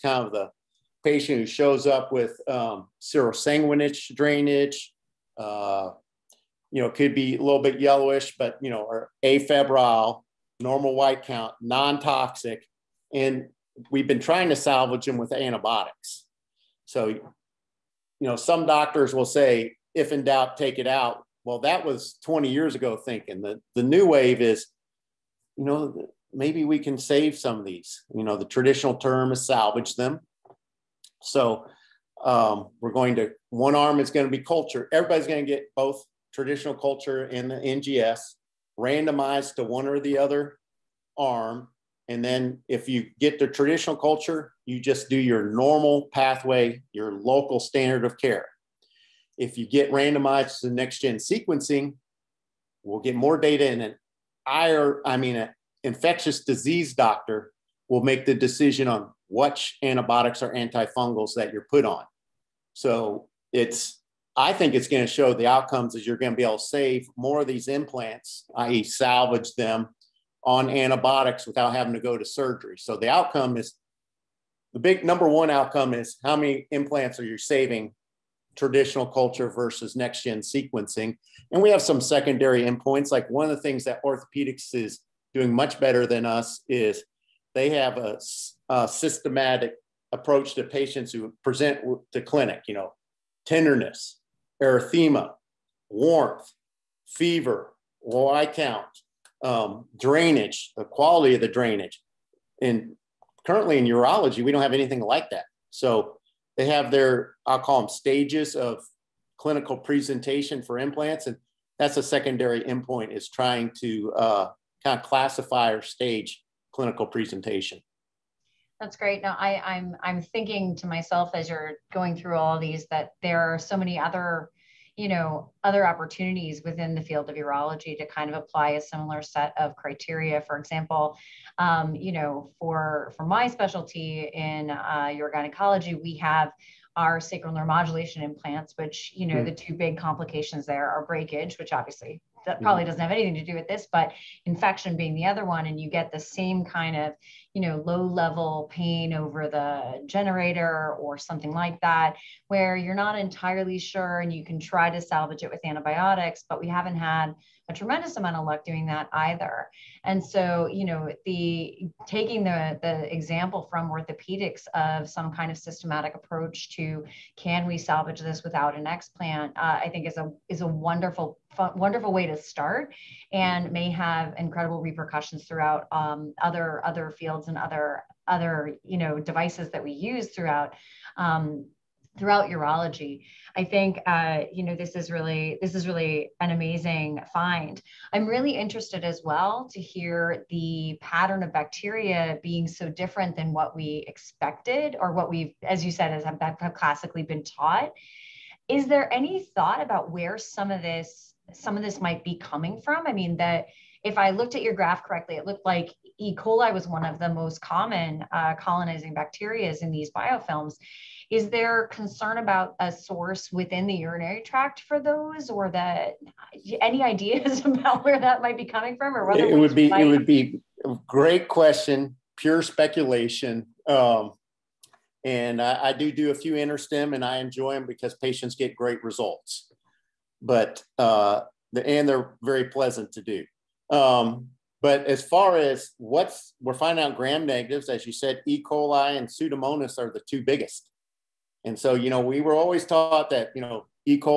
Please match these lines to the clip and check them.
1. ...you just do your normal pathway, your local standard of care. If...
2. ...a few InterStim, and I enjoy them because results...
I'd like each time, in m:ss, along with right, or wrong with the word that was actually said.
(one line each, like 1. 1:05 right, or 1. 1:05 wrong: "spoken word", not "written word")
1. 0:44 right
2. 3:46 wrong: "patients", not "results".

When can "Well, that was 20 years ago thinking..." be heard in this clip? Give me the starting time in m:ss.
0:21.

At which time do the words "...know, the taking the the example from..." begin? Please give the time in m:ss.
2:40.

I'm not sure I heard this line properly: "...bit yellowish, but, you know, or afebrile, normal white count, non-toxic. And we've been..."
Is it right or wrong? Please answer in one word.
right.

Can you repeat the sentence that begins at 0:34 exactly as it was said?
Everybody's going to get both traditional culture and the NGS randomized to one or the other arm.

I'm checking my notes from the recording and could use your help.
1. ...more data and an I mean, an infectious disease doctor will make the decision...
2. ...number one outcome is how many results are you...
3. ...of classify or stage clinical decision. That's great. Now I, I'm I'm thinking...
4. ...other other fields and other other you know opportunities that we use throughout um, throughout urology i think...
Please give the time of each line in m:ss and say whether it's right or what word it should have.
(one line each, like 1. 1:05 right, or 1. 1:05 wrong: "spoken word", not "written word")
1. 0:53 right
2. 1:15 wrong: "implants", not "results"
3. 1:54 wrong: "presentation", not "decision"
4. 2:56 wrong: "devices", not "opportunities".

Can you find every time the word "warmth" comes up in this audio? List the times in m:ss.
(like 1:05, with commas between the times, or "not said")
1:35.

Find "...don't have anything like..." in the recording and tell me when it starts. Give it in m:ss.
1:44.